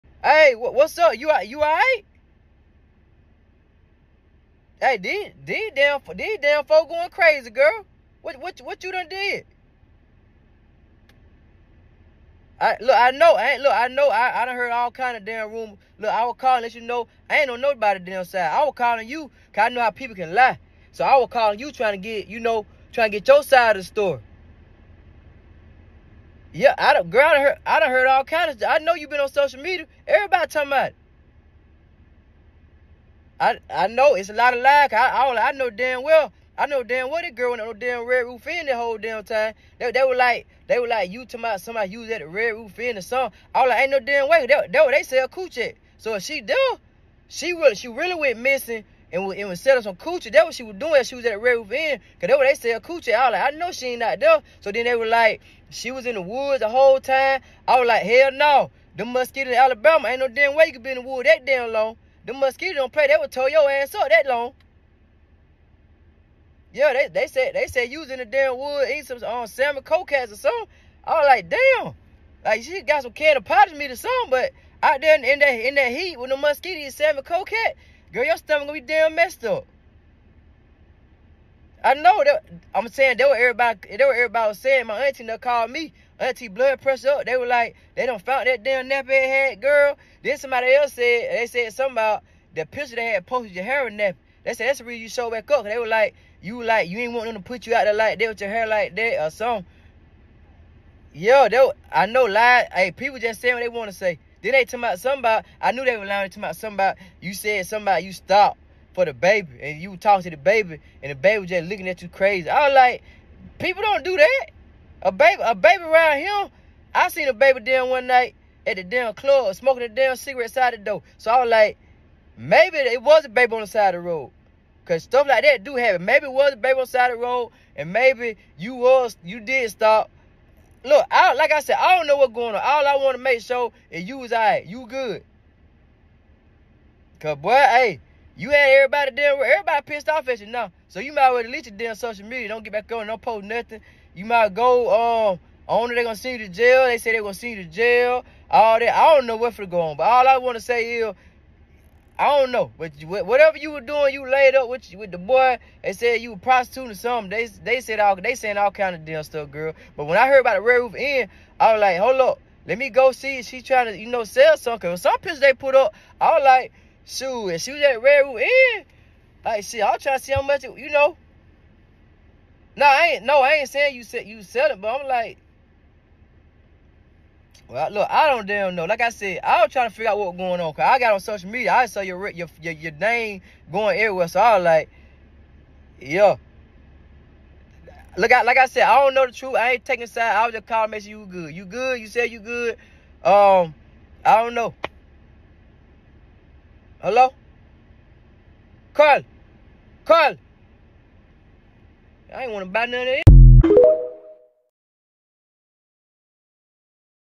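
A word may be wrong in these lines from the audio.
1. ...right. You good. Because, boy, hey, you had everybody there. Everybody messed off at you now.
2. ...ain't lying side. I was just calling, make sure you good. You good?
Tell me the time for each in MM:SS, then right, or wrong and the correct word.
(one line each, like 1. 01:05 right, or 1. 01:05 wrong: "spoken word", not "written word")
1. 02:14 wrong: "pissed", not "messed"
2. 03:09 wrong: "taking", not "lying".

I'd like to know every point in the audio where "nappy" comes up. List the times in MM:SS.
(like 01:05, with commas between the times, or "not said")
01:28, 01:33.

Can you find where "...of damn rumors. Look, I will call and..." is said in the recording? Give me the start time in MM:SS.
00:15.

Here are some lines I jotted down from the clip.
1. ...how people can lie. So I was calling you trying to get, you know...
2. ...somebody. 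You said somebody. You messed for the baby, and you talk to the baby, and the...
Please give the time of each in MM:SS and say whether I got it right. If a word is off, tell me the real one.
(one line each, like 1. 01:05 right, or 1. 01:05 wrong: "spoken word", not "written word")
1. 00:19 right
2. 01:46 wrong: "stopped", not "messed".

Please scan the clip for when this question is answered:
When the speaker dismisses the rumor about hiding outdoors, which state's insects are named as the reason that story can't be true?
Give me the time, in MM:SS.
00:59.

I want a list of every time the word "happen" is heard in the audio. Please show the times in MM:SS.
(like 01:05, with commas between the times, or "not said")
02:05.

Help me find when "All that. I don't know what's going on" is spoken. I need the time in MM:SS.
02:28.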